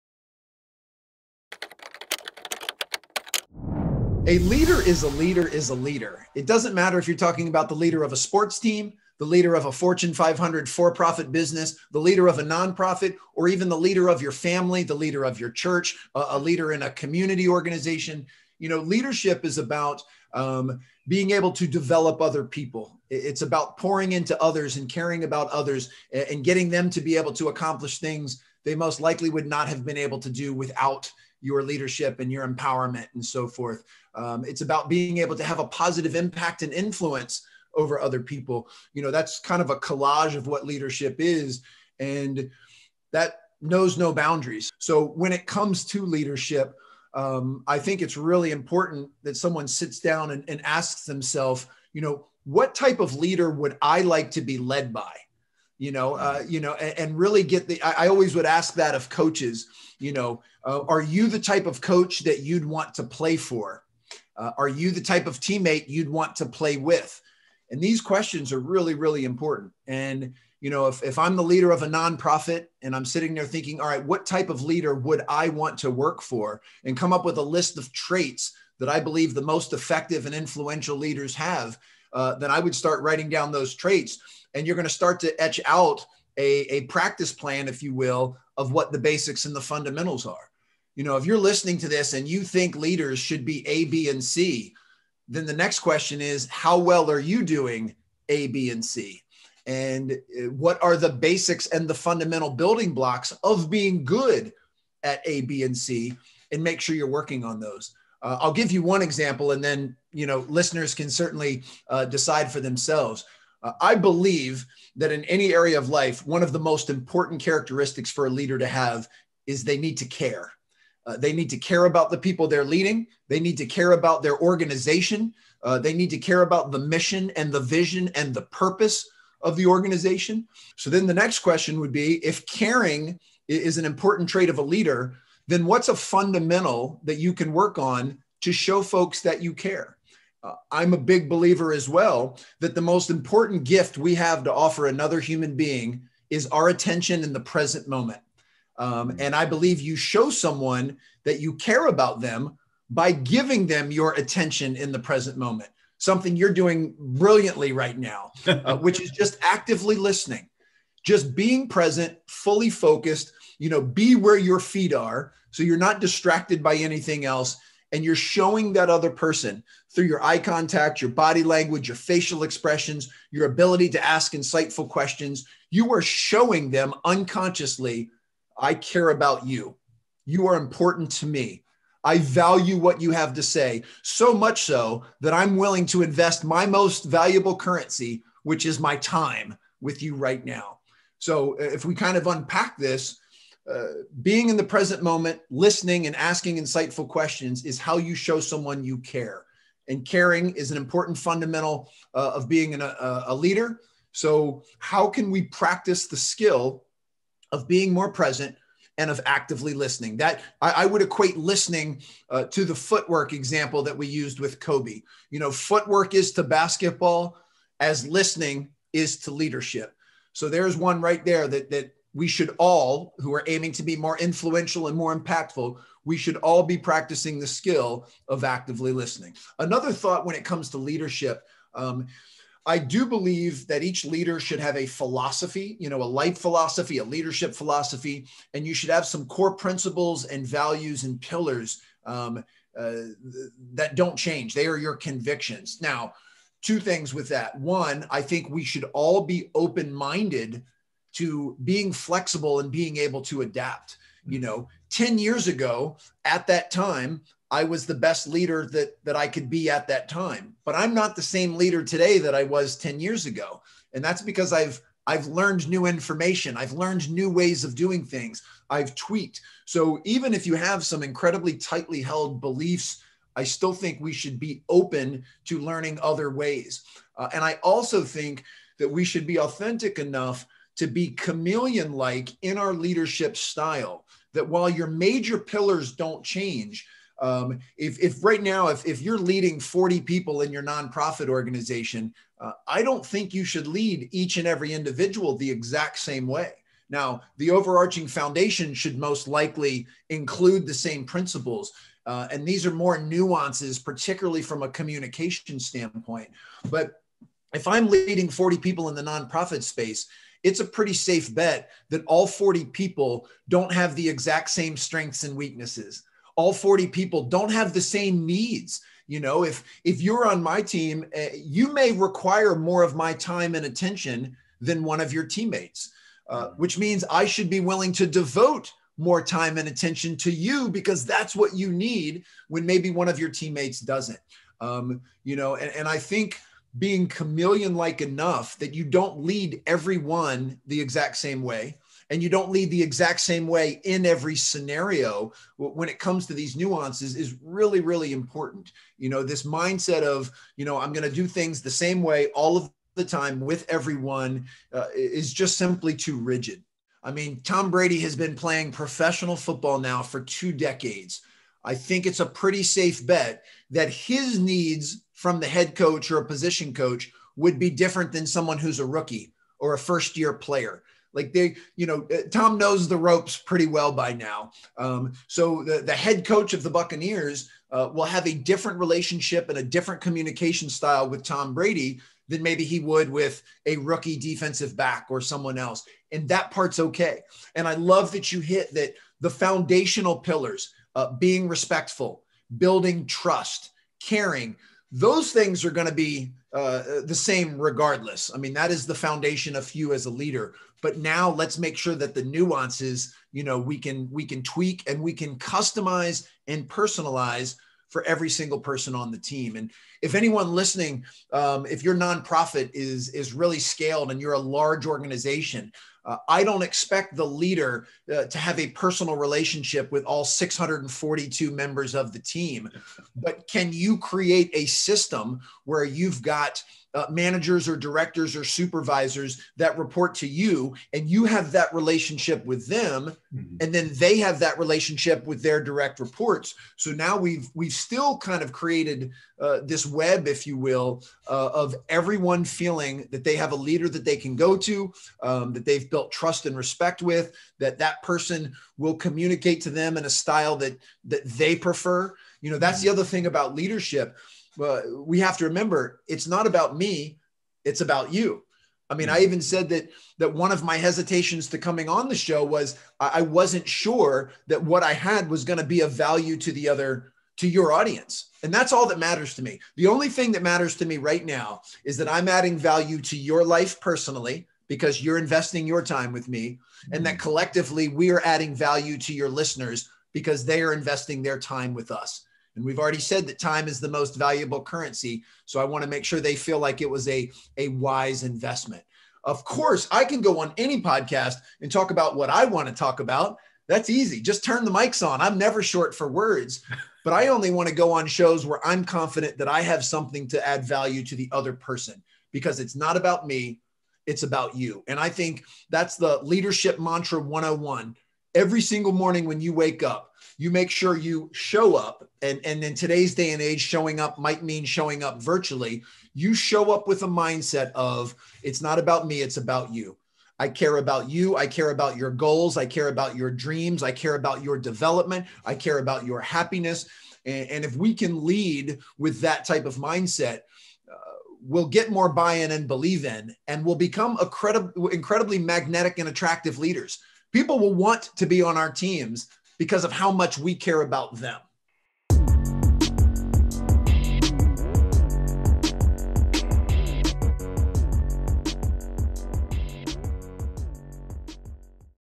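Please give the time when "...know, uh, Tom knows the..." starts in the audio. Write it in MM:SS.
06:11.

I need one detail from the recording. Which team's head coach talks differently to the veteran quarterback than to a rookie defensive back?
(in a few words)
Buccaneers.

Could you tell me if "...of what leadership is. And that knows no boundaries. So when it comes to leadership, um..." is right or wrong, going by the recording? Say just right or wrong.
right.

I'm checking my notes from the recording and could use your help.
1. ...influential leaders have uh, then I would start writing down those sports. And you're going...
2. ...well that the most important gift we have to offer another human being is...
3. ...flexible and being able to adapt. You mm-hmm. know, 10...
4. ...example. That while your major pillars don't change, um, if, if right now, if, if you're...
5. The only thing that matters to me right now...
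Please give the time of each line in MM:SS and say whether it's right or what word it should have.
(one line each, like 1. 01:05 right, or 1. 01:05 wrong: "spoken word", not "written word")
1. 01:20 wrong: "traits", not "sports"
2. 02:21 right
3. 04:11 right
4. 04:43 wrong: "style", not "example"
5. 07:49 right.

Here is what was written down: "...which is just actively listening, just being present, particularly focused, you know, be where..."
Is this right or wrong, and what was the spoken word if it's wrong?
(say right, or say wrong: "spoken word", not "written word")
wrong: "fully", not "particularly".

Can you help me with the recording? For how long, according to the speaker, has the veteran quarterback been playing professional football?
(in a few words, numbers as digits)
Two decades.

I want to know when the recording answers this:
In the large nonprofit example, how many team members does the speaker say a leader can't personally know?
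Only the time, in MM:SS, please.
07:00.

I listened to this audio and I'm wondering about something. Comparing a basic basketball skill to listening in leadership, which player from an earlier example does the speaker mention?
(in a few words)
Kobe.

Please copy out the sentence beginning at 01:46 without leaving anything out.
And make sure you're working on those.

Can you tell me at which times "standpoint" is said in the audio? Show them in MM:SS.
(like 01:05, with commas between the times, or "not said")
05:05.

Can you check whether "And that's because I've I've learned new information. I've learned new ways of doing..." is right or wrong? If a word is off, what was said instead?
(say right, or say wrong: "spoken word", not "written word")
right.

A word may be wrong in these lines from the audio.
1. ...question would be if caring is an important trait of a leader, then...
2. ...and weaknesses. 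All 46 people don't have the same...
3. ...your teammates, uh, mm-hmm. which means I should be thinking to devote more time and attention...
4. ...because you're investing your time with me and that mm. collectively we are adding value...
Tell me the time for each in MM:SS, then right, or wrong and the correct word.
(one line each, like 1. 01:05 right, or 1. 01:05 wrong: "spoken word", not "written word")
1. 02:11 right
2. 05:15 wrong: "40", not "46"
3. 05:25 wrong: "willing", not "thinking"
4. 07:54 right.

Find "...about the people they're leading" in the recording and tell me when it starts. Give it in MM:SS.
02:01.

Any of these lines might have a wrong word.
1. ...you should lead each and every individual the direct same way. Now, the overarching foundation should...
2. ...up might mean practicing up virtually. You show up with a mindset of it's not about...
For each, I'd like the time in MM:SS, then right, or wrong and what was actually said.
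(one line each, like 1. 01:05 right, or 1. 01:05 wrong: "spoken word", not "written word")
1. 04:53 wrong: "exact", not "direct"
2. 08:33 wrong: "showing", not "practicing".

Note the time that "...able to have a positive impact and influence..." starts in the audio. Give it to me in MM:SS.
00:35.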